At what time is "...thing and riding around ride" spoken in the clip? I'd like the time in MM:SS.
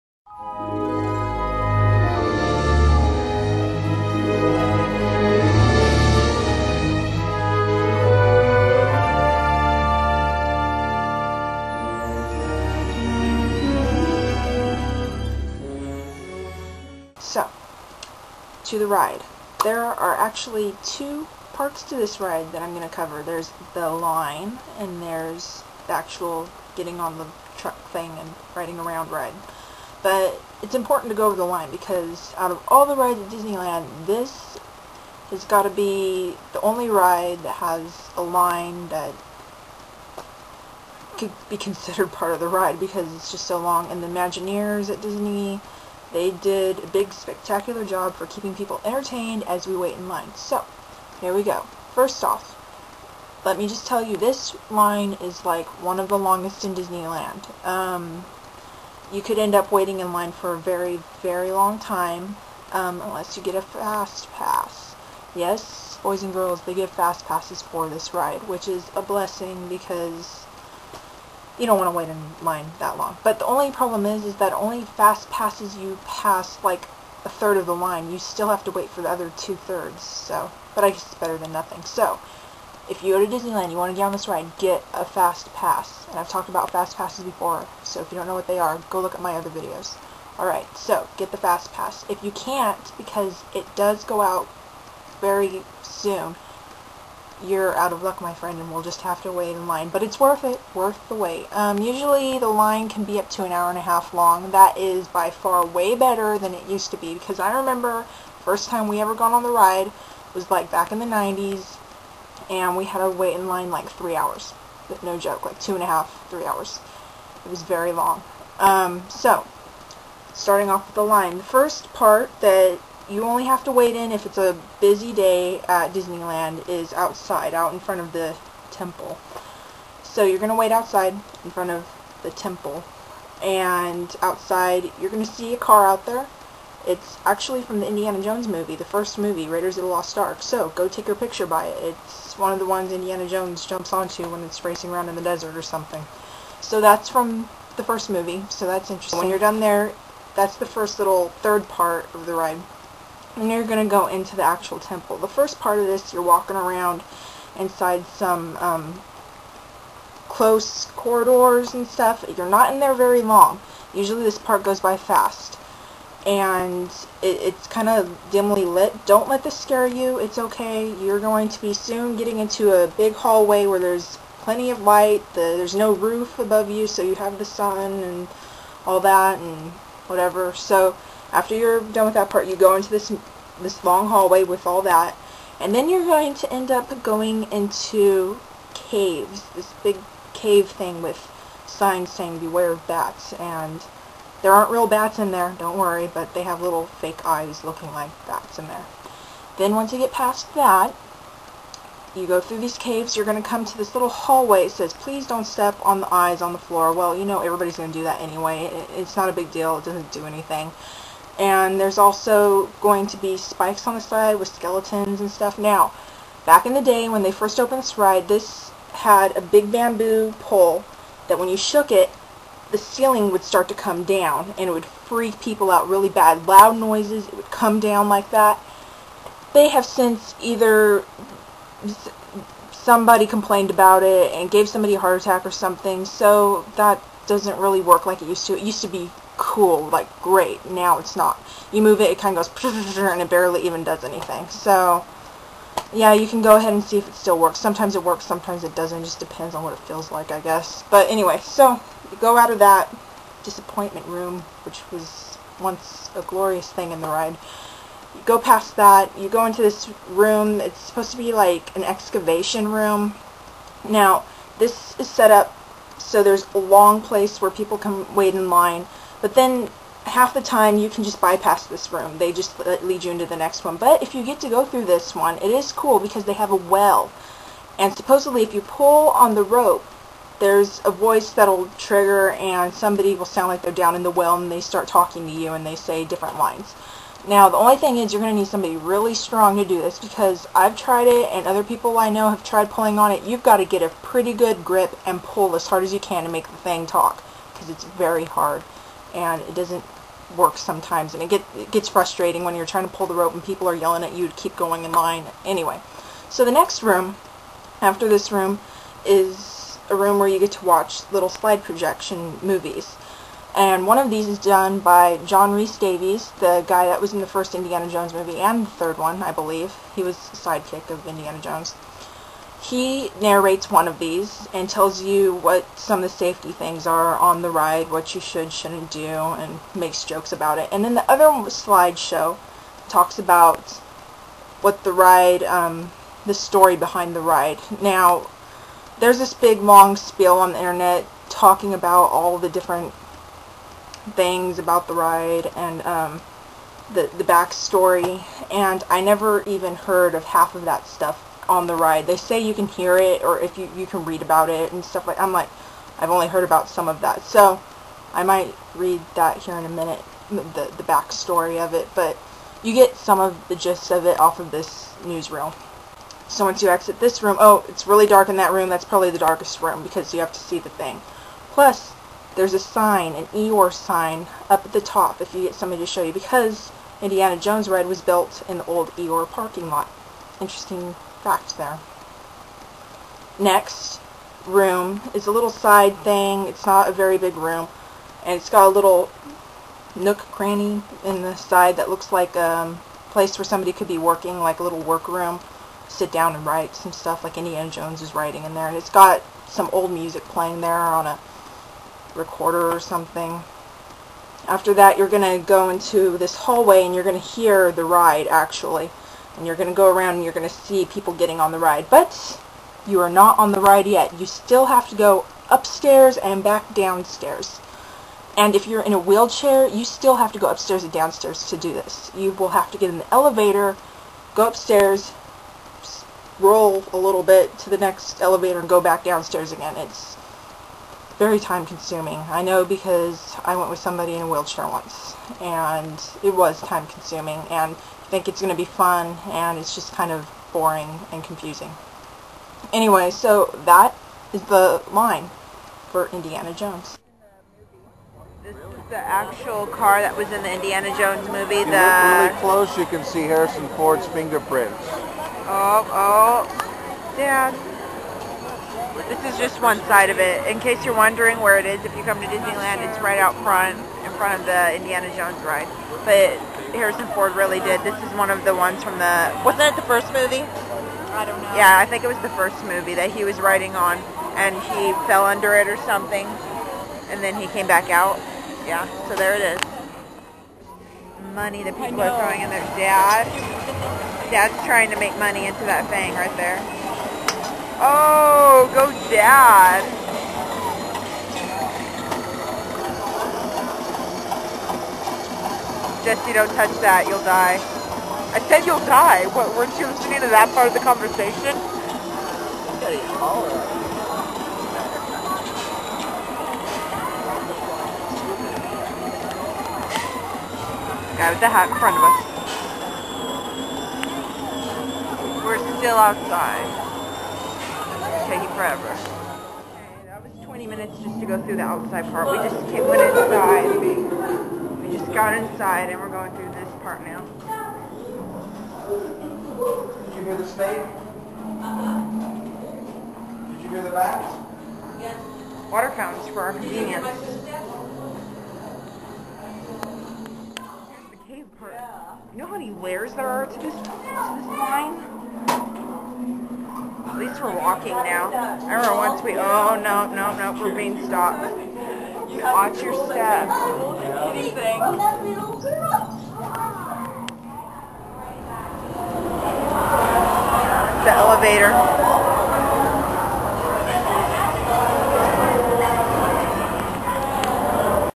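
00:27.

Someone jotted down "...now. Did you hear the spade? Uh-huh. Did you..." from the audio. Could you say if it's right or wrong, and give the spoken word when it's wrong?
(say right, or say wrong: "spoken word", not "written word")
right.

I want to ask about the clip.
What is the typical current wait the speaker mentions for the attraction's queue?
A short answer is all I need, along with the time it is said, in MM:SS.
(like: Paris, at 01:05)
An hour and a half, at 01:43.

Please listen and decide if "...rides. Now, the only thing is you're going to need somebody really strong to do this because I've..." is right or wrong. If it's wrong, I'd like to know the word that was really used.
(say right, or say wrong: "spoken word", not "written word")
wrong: "lines", not "rides".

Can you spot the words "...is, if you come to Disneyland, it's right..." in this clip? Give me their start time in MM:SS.
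07:41.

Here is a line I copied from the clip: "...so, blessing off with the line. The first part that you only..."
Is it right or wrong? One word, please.
wrong.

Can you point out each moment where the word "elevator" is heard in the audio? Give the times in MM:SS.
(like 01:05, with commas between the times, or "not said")
07:03, 07:08, 09:21.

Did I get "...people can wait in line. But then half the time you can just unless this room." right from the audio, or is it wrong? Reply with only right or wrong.
wrong.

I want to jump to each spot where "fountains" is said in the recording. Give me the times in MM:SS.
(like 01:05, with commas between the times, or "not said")
08:55.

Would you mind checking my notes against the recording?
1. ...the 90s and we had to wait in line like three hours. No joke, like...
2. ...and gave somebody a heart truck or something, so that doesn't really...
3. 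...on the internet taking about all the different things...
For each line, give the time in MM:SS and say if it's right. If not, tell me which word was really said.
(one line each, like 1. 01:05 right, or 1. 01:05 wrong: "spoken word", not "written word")
1. 01:50 right
2. 03:54 wrong: "attack", not "truck"
3. 05:40 wrong: "talking", not "taking".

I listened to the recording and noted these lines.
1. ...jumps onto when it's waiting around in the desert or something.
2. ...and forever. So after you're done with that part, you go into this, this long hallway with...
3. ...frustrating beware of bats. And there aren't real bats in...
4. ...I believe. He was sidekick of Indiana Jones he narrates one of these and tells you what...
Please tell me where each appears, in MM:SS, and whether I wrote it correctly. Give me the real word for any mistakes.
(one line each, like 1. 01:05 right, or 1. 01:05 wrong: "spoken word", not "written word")
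1. 02:23 wrong: "racing", not "waiting"
2. 02:59 wrong: "whatever", not "forever"
3. 03:12 wrong: "saying", not "frustrating"
4. 05:19 right.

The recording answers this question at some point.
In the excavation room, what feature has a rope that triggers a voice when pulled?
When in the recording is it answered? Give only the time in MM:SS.
04:36.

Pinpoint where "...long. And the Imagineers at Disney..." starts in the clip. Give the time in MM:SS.
00:43.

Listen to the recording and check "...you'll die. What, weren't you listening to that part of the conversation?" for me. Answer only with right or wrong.
right.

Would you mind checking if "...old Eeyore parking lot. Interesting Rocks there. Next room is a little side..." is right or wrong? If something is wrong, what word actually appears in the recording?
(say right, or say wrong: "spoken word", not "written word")
right.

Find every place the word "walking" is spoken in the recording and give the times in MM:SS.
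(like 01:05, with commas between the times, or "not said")
02:36, 09:07.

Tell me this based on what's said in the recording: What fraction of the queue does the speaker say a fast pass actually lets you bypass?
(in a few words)
A third.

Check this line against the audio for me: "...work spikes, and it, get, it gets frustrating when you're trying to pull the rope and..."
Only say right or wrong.
wrong.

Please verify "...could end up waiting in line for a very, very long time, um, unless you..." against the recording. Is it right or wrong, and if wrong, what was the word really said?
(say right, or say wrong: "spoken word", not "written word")
right.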